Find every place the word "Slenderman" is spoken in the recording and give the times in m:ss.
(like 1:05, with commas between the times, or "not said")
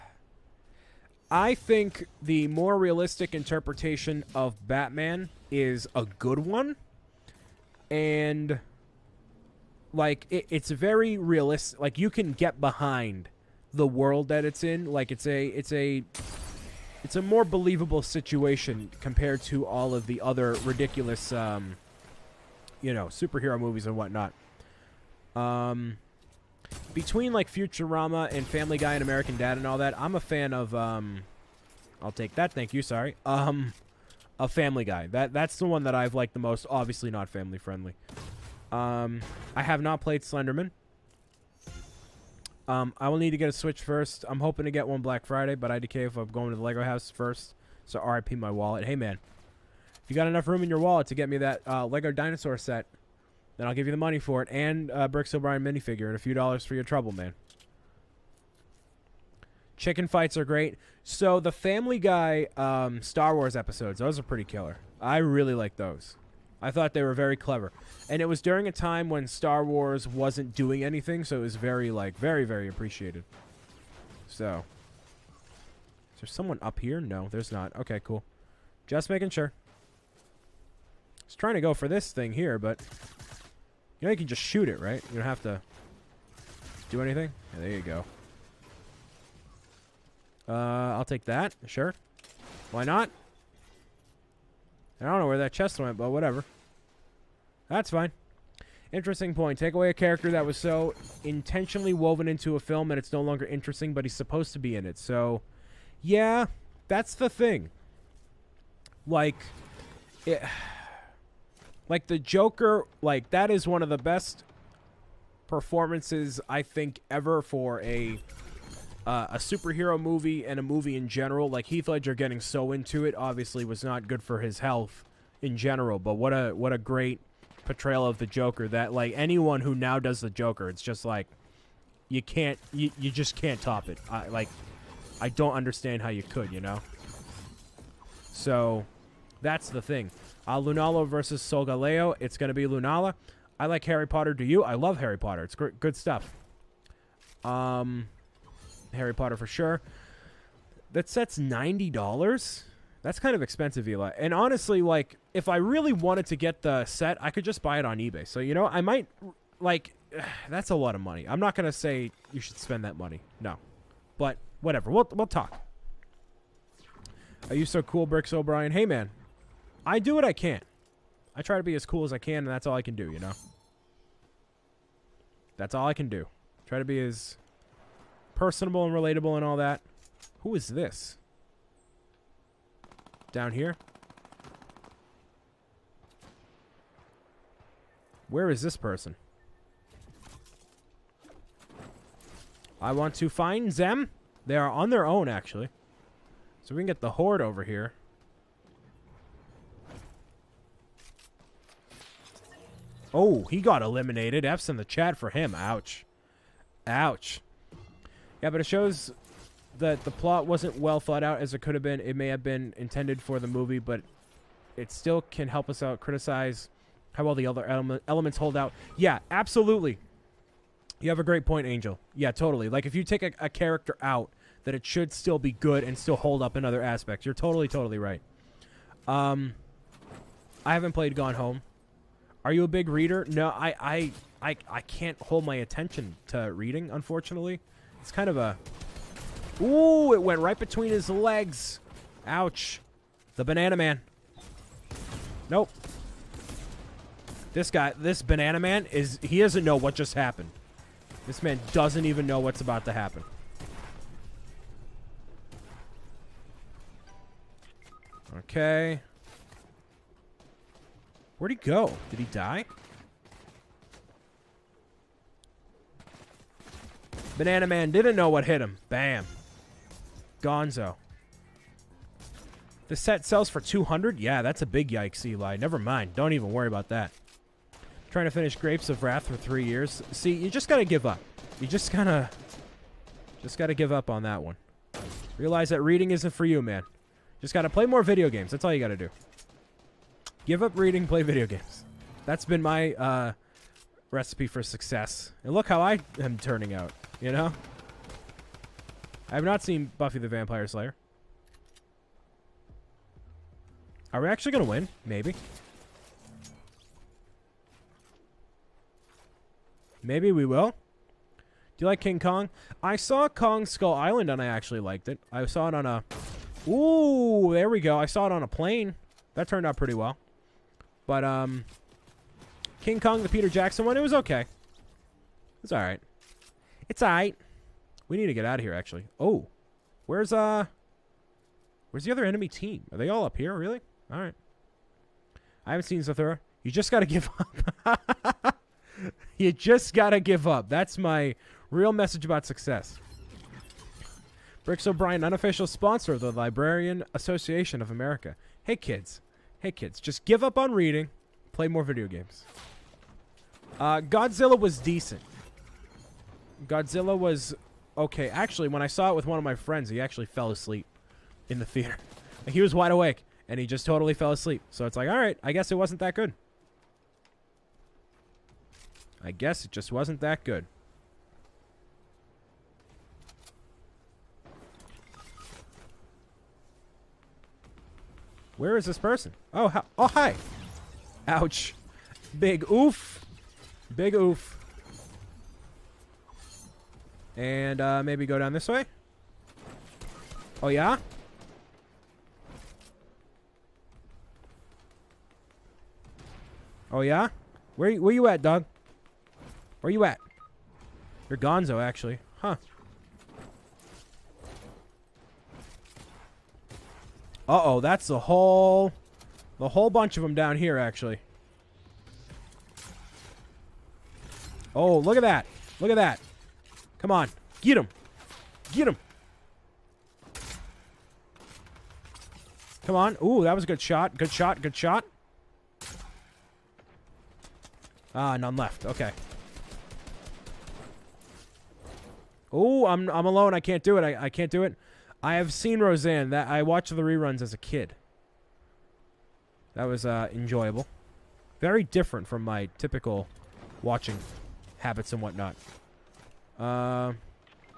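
0:40.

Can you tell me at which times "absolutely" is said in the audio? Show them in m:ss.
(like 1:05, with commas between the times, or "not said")
3:39.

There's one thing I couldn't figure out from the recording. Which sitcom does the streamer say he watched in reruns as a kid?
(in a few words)
Roseanne.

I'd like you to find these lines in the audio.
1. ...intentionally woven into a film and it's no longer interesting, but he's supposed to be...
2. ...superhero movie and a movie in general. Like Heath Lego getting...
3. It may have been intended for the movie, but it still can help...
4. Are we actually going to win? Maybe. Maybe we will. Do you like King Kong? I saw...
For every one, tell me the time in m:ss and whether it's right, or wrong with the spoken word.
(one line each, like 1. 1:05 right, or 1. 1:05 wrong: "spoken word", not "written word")
1. 1:41 right
2. 1:59 wrong: "Ledger", not "Lego"
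3. 3:32 right
4. 5:04 right.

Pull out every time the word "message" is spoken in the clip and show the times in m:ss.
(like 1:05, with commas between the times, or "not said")
5:41.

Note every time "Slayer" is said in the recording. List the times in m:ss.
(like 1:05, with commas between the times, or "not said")
5:00.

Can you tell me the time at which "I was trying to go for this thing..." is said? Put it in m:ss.
1:20.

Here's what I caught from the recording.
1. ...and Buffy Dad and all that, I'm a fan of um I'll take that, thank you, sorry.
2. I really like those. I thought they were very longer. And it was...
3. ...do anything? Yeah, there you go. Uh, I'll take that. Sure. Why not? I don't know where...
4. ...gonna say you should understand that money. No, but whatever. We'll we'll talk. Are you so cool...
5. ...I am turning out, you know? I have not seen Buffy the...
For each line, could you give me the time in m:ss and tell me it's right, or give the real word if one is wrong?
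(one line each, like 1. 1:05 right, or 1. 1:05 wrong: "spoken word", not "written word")
1. 0:28 wrong: "American", not "Buffy"
2. 1:05 wrong: "clever", not "longer"
3. 1:26 right
4. 2:41 wrong: "spend", not "understand"
5. 4:55 right.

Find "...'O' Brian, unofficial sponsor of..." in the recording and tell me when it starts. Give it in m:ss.
5:44.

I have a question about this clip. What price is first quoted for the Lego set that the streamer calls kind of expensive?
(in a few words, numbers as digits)
$90.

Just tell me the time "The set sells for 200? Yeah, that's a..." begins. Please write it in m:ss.
4:32.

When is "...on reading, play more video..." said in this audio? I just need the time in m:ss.
5:50.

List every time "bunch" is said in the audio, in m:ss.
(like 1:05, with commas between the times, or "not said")
6:49.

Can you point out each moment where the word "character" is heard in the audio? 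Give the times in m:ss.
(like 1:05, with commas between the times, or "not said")
1:39, 3:43.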